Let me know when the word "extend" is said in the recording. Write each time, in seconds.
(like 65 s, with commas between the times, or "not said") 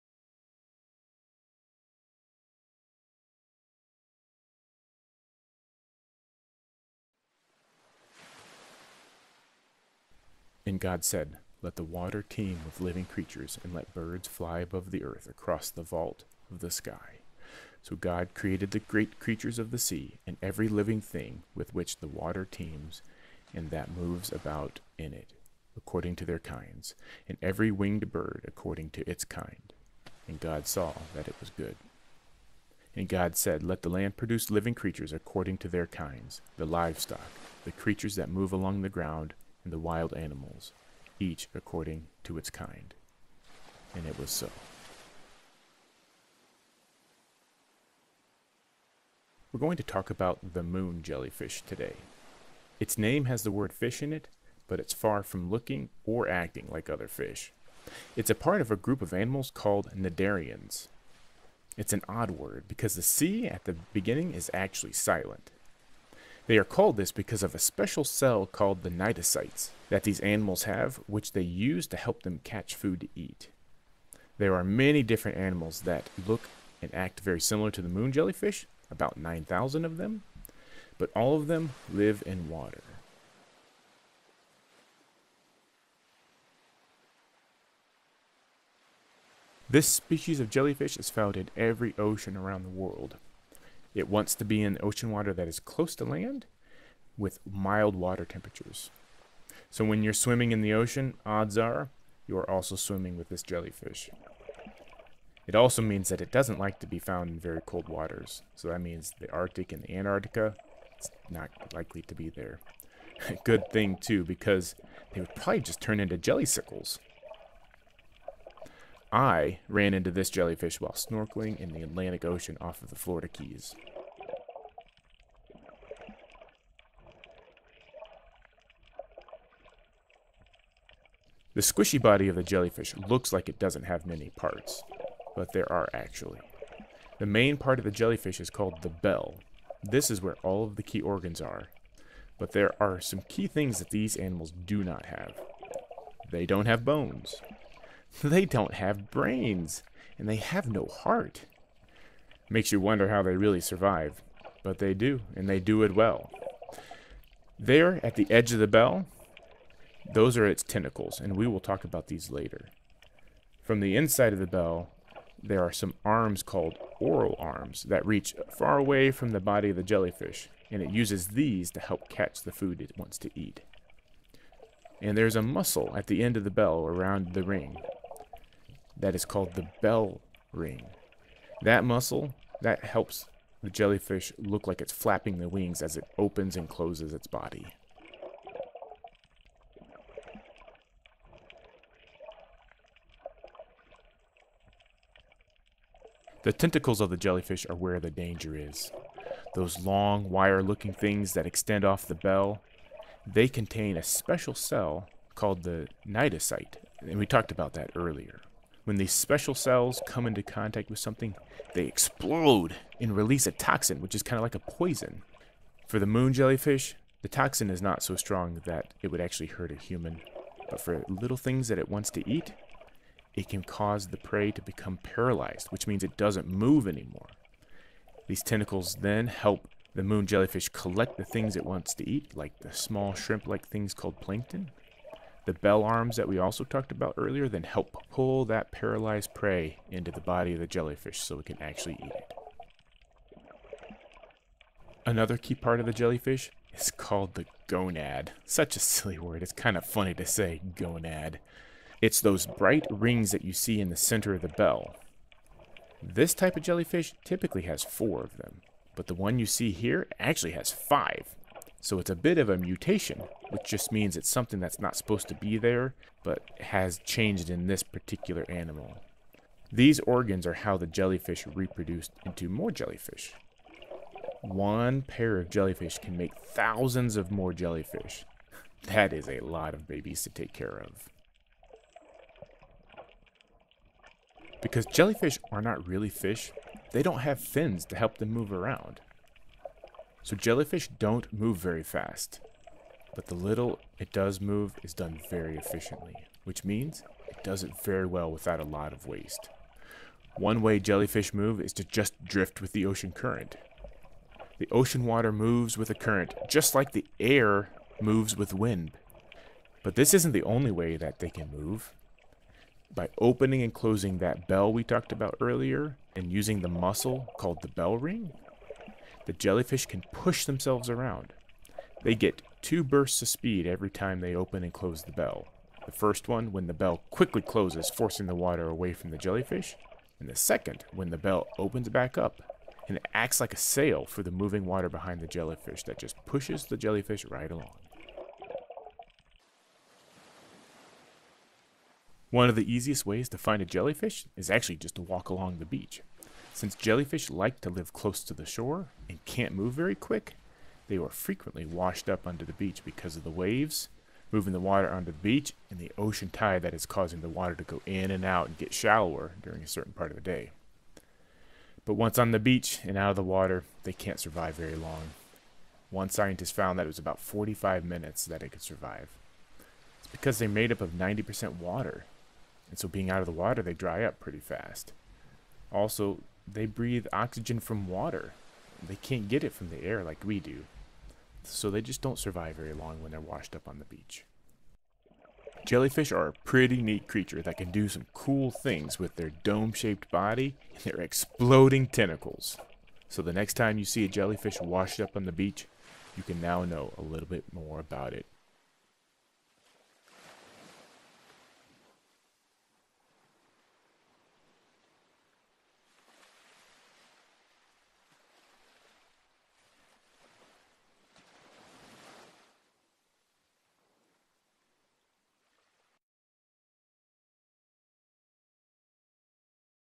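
201 s.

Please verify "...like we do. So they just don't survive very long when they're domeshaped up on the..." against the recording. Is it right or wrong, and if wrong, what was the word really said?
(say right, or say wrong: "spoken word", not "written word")
wrong: "washed", not "domeshaped".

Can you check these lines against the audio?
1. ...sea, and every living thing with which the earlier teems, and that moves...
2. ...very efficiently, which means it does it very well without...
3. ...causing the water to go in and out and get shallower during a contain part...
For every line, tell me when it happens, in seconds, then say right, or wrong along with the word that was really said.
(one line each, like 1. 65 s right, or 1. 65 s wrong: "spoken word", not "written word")
1. 19 s wrong: "water", not "earlier"
2. 295 s right
3. 356 s wrong: "certain", not "contain".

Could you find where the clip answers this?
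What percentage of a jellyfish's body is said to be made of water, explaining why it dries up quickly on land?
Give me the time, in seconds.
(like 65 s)
370 s.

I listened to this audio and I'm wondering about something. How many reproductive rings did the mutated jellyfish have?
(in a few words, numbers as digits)
5.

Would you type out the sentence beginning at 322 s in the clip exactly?
They get two bursts of speed every time they open and close the bell.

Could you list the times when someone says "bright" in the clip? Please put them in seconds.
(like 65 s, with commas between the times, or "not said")
252 s.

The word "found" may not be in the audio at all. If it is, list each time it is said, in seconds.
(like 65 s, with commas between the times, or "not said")
91 s, 106 s, 366 s.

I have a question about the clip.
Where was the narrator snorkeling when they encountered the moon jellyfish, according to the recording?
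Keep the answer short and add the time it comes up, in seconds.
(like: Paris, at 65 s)
Florida Keys, at 122 s.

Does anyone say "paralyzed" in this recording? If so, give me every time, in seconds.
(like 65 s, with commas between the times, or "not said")
224 s, 238 s.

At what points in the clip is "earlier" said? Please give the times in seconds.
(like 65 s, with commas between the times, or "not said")
207 s, 237 s, 315 s.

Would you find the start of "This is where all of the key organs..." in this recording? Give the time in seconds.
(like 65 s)
139 s.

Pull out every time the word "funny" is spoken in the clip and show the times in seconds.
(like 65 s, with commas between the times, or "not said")
249 s.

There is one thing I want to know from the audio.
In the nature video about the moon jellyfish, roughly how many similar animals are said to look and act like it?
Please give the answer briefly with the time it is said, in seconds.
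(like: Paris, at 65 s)
9,000, at 78 s.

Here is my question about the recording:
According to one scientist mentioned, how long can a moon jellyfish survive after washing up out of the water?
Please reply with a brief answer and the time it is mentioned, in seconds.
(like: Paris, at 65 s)
45 minutes, at 367 s.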